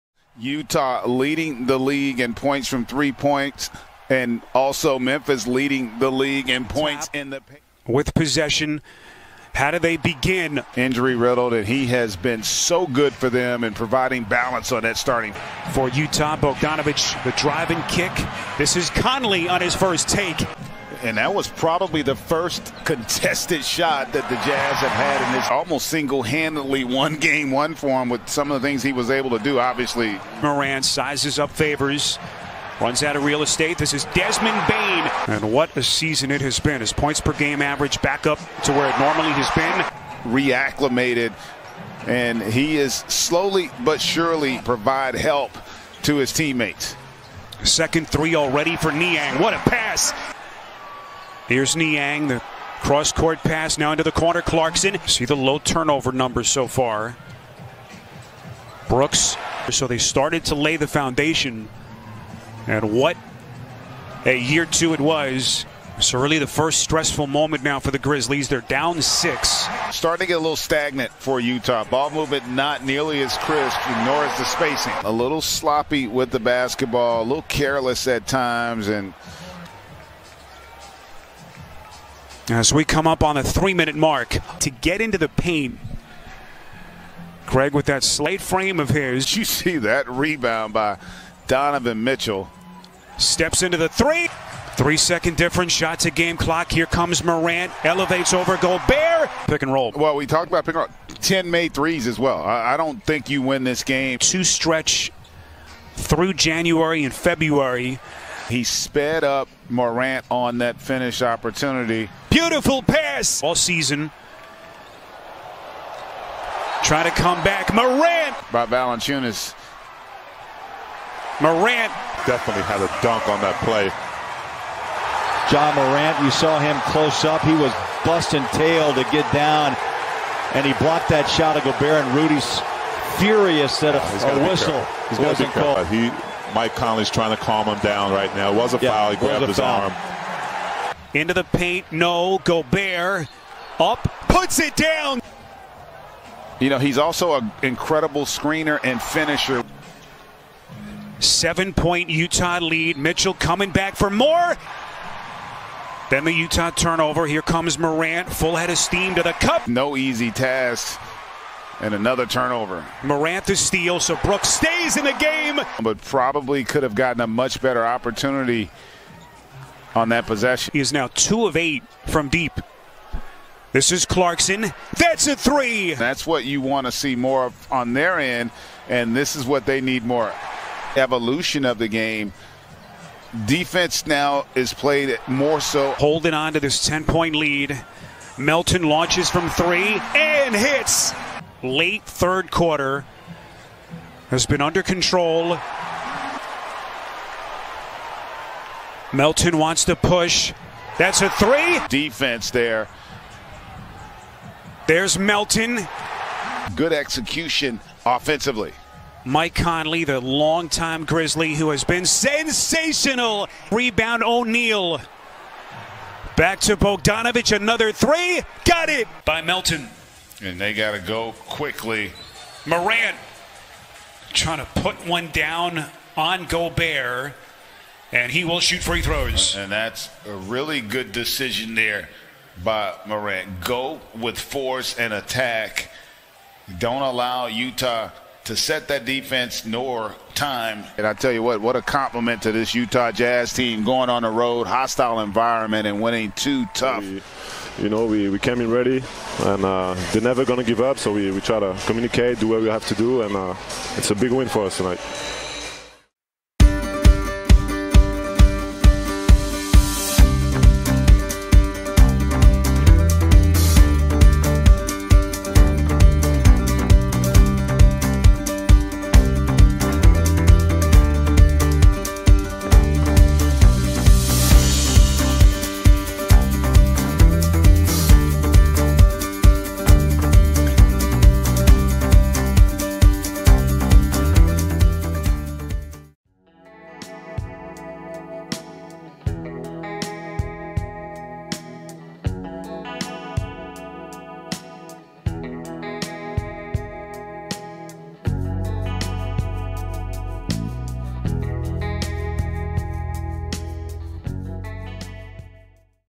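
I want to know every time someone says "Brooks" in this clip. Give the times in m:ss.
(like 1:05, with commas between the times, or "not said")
0:58, 2:44.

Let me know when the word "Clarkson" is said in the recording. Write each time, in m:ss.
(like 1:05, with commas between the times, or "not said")
0:54, 2:54.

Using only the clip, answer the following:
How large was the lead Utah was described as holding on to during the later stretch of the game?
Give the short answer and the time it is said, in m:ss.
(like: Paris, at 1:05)
10 points, at 3:06.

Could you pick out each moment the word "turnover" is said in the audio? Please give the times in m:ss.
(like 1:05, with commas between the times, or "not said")
0:55, 2:36, 2:42.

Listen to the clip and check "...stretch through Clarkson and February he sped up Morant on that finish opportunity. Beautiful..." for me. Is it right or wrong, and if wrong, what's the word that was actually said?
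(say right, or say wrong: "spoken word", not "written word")
wrong: "January", not "Clarkson".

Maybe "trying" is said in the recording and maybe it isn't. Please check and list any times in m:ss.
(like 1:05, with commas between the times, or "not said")
2:17, 3:44.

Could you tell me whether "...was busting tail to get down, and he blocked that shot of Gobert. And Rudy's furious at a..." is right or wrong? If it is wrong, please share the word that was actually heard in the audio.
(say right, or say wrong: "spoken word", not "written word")
right.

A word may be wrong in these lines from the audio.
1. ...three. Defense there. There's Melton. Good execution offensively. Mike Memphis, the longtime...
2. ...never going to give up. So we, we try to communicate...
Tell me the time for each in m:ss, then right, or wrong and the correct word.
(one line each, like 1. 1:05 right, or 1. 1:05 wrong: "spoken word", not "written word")
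1. 3:21 wrong: "Conley", not "Memphis"
2. 4:10 right.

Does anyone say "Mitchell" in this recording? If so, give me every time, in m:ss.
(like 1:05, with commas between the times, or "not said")
1:32, 2:32.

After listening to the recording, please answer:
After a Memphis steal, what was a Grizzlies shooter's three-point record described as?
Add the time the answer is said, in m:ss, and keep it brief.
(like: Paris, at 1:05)
2 of 8, at 2:51.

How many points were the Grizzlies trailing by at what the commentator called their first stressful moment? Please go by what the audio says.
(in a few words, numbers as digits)
6.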